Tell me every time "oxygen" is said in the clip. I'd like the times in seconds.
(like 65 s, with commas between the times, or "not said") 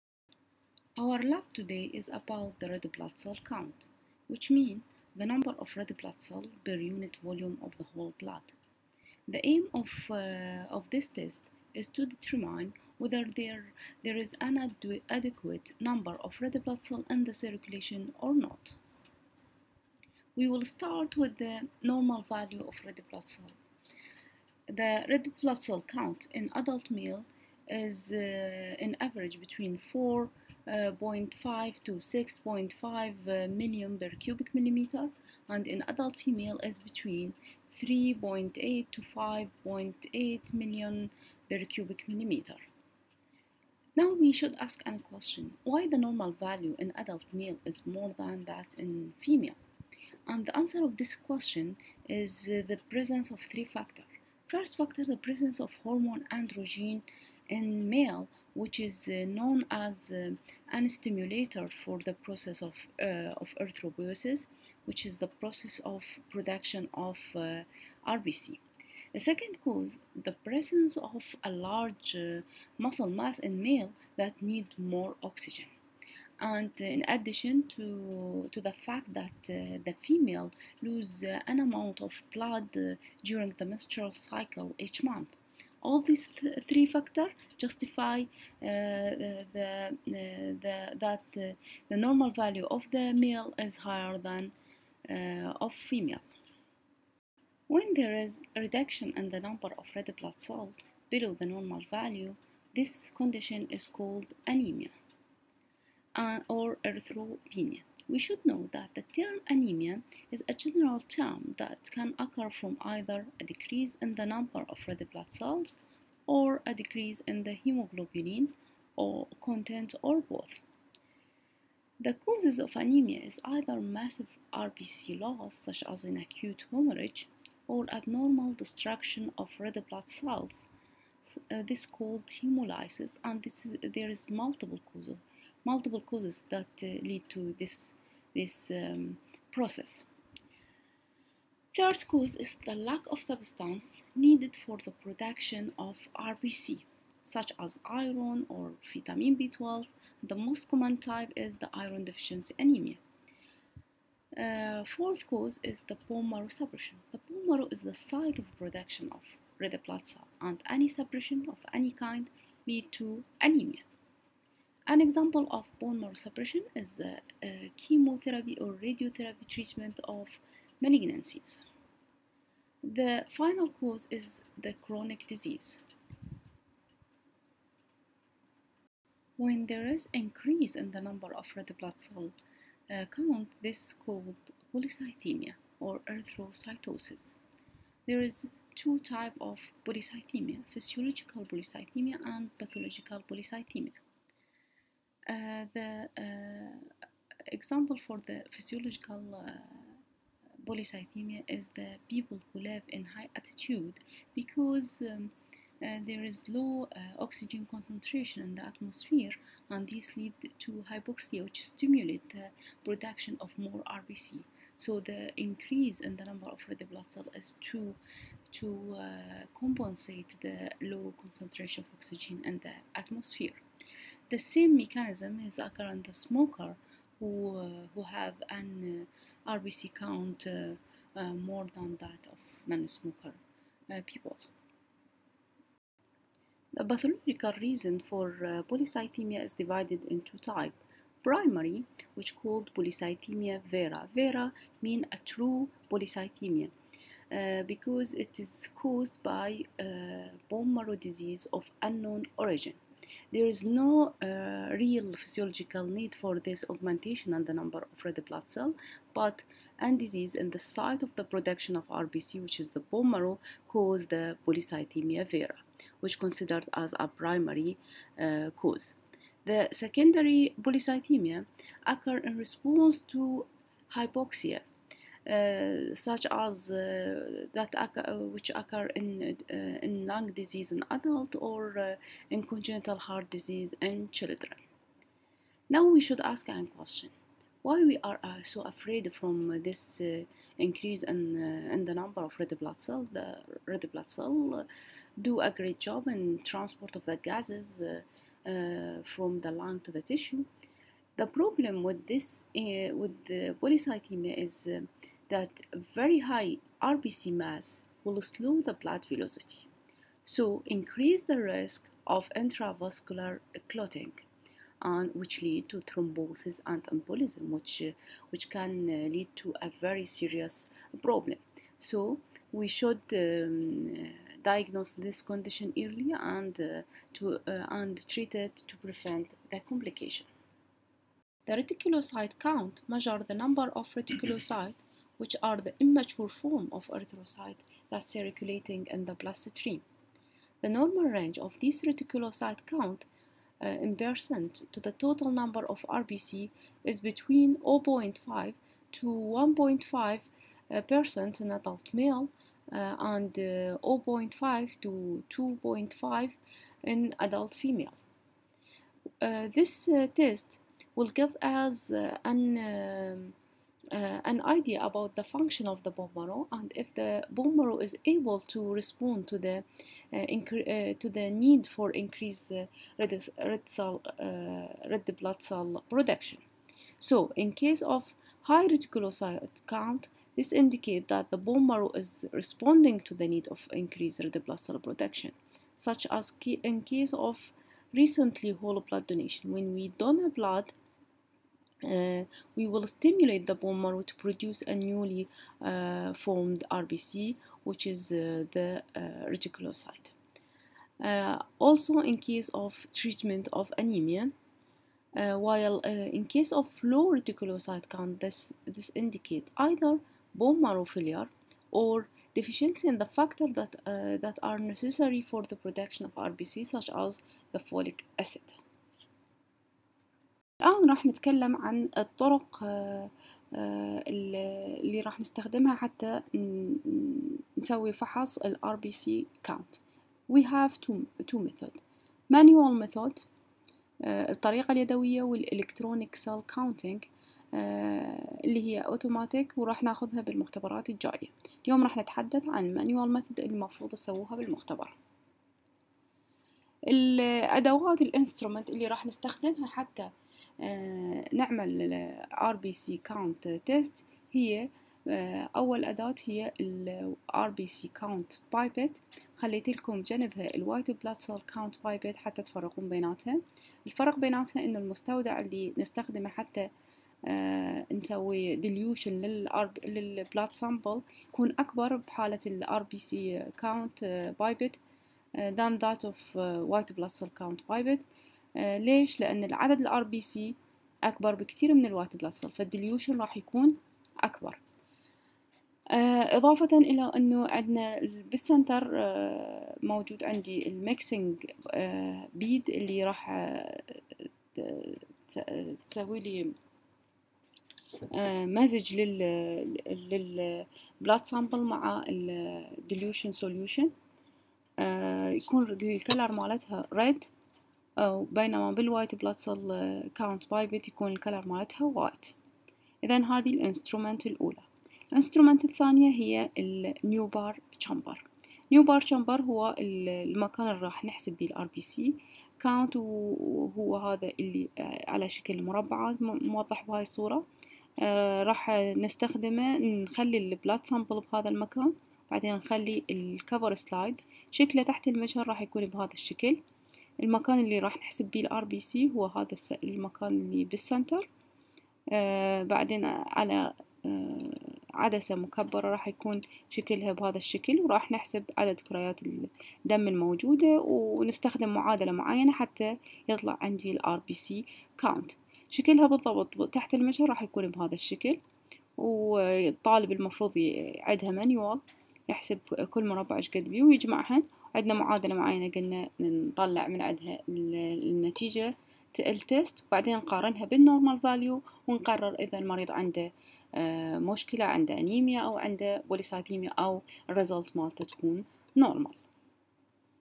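75 s, 207 s, 221 s.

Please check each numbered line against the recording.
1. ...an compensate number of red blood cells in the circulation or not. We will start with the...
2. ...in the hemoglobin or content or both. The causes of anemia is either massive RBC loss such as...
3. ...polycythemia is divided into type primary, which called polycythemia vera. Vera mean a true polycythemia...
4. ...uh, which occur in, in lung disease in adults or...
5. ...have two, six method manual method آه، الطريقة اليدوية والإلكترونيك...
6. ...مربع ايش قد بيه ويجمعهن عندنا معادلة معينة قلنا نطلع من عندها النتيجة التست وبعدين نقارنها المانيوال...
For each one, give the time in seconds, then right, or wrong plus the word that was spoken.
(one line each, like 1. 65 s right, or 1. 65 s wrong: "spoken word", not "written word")
1. 14 s wrong: "adequate", not "compensate"
2. 117 s right
3. 238 s right
4. 278 s right
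5. 430 s wrong: "two", not "six"
6. 563 s wrong: "بالنورمال", not "المانيوال".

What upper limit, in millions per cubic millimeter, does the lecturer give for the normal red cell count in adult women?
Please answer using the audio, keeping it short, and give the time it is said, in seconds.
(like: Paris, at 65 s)
5.8, at 39 s.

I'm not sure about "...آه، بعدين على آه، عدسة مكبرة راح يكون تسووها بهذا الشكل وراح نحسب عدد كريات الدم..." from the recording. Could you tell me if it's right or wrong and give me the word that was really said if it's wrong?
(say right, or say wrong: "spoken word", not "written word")
wrong: "شكلها", not "تسووها".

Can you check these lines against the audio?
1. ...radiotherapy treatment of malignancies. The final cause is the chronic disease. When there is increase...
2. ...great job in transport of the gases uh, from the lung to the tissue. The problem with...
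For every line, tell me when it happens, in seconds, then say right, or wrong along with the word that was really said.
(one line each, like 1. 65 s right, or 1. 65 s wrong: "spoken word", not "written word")
1. 168 s right
2. 295 s right.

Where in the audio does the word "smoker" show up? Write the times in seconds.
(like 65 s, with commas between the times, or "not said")
226 s, 232 s.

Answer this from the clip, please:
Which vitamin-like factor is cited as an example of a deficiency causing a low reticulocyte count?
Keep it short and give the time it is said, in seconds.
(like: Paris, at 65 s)
Folic acid, at 417 s.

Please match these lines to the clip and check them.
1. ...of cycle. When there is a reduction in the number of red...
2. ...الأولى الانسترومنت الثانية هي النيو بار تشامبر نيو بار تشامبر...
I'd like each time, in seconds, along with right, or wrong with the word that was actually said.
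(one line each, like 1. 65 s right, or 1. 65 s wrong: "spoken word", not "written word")
1. 95 s wrong: "female", not "cycle"
2. 514 s right.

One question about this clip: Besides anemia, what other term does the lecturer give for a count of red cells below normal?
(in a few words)
Erythropenia.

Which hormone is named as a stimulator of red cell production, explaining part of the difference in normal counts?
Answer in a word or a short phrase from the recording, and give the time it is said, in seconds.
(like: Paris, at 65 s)
Androgen, at 56 s.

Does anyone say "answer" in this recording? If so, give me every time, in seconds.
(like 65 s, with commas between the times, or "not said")
50 s.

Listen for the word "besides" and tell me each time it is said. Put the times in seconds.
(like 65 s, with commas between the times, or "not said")
not said.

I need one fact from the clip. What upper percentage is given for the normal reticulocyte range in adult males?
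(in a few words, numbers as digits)
1.5%.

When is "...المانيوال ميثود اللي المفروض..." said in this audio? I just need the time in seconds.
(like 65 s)
442 s.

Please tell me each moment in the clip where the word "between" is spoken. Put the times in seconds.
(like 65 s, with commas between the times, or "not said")
29 s, 36 s, 346 s.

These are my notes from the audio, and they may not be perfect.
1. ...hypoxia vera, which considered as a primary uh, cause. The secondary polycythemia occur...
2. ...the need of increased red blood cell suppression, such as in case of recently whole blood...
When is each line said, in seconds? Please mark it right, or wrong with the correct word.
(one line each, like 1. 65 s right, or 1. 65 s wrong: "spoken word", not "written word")
1. 264 s wrong: "polycythemia", not "hypoxia"
2. 383 s wrong: "production", not "suppression".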